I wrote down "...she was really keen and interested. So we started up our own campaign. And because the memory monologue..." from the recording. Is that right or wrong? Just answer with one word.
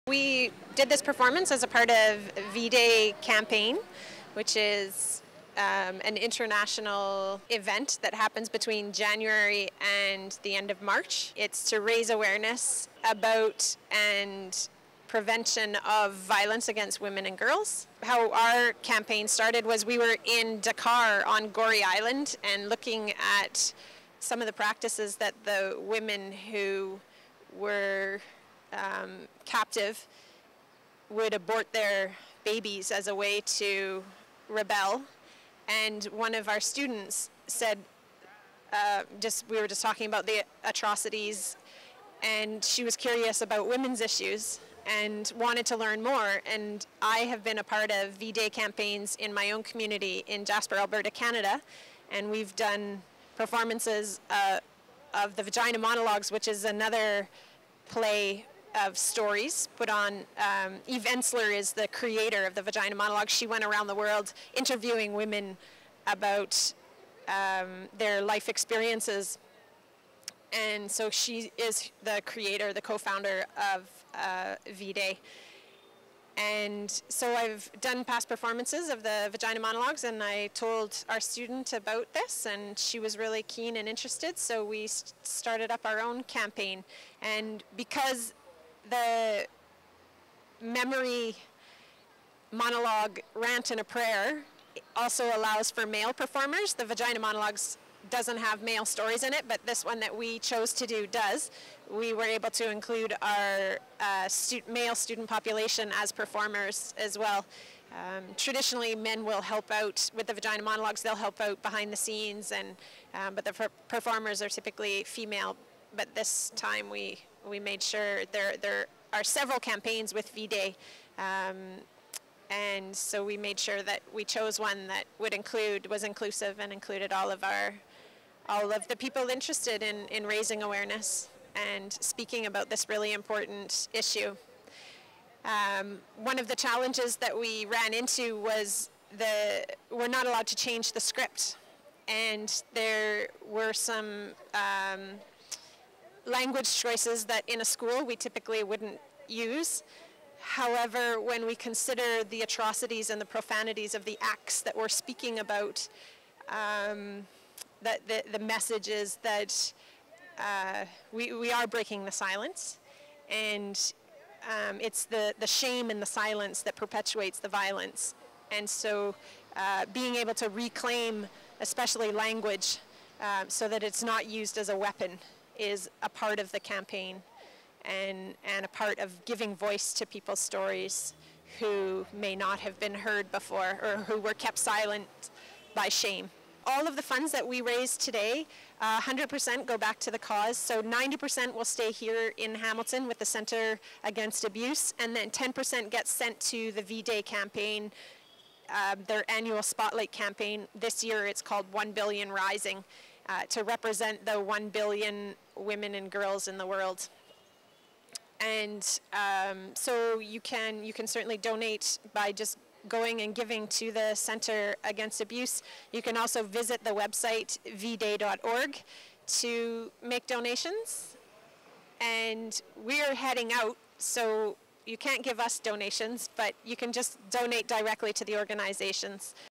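right.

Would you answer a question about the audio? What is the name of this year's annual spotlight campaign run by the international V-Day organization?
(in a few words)
1 Billion Rising.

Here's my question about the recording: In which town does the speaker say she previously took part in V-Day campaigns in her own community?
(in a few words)
Jasper, Alberta.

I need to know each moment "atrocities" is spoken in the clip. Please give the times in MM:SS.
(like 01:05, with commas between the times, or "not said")
00:40, 02:32.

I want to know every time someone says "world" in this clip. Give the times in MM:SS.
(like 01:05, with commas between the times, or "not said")
01:03, 03:26.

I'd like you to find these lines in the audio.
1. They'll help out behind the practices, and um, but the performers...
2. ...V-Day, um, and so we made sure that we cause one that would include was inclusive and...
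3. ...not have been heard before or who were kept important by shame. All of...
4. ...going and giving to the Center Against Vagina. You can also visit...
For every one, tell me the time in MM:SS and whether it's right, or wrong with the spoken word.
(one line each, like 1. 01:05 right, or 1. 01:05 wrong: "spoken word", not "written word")
1. 01:51 wrong: "scenes", not "practices"
2. 02:00 wrong: "chose", not "cause"
3. 03:02 wrong: "silent", not "important"
4. 03:32 wrong: "Abuse", not "Vagina".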